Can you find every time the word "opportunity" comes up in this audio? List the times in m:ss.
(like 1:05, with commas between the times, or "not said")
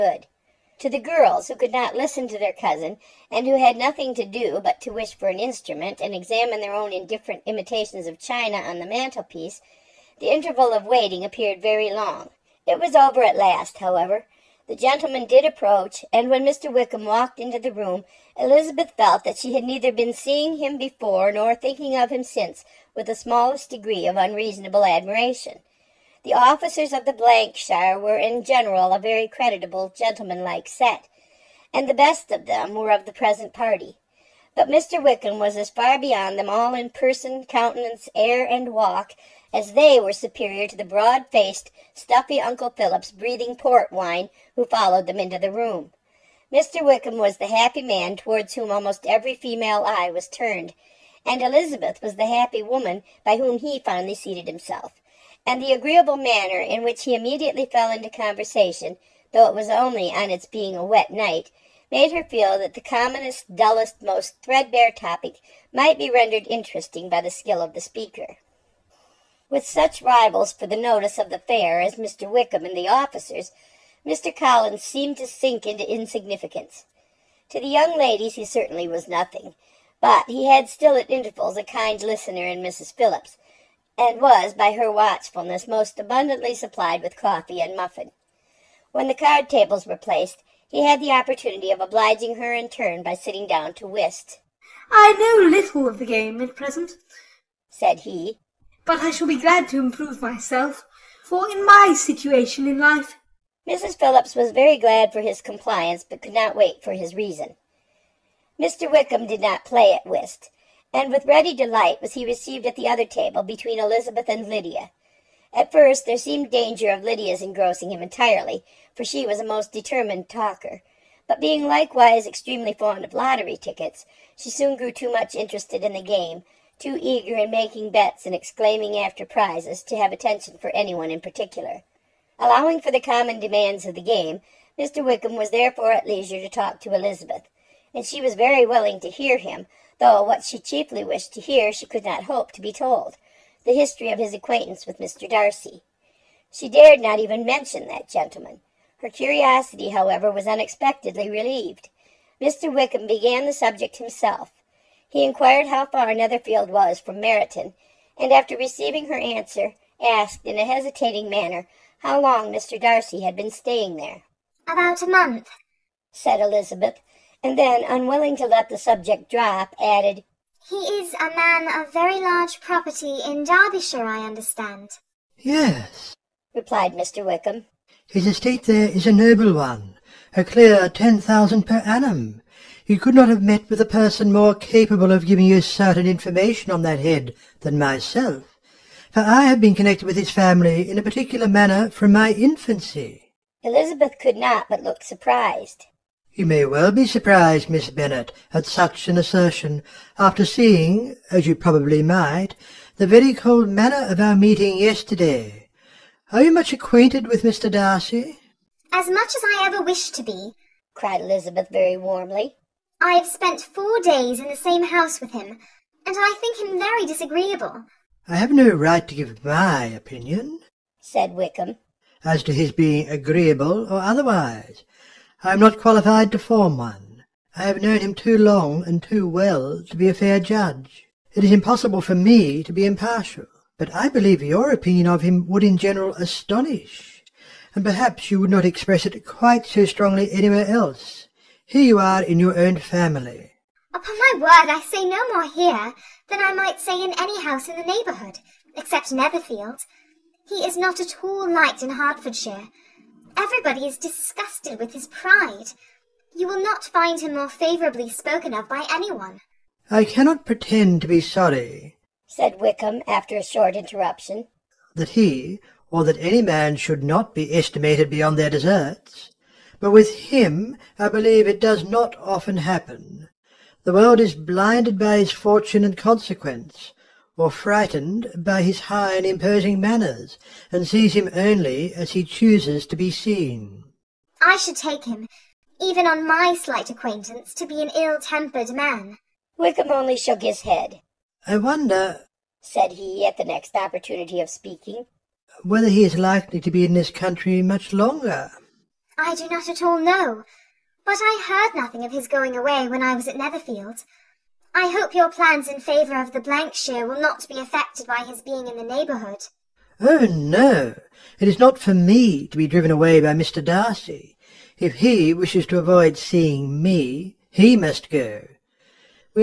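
1:31, 4:53.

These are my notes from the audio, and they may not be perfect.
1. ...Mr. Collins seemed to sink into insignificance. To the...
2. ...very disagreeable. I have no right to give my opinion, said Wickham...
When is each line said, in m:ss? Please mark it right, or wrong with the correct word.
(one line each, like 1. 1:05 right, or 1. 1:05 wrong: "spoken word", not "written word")
1. 1:14 right
2. 3:36 right.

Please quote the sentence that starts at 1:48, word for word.
Wickham did not play at whist, and with ready delight was he received at the other table between Elizabeth and Lydia.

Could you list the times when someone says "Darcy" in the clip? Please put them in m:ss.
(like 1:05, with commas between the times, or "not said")
2:25, 2:42, 3:27, 5:13.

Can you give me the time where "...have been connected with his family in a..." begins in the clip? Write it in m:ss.
3:09.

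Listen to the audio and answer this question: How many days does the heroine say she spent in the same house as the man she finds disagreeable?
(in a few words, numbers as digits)
4.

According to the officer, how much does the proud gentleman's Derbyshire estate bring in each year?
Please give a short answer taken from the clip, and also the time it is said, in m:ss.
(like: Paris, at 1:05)
10,000, at 3:00.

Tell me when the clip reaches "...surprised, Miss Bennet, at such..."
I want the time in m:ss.
3:17.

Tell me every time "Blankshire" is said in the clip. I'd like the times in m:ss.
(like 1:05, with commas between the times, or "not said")
0:27, 5:06.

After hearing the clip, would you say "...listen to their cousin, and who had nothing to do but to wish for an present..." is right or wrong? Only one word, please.
wrong.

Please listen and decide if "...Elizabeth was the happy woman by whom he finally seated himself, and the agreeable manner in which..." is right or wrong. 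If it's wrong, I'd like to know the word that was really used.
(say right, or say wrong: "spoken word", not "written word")
right.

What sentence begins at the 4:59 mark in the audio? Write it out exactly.
I do not at all know, but I heard nothing of his going away when I was at Netherfield.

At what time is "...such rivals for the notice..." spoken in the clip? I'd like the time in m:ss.
1:09.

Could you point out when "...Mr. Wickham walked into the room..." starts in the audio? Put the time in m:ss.
0:16.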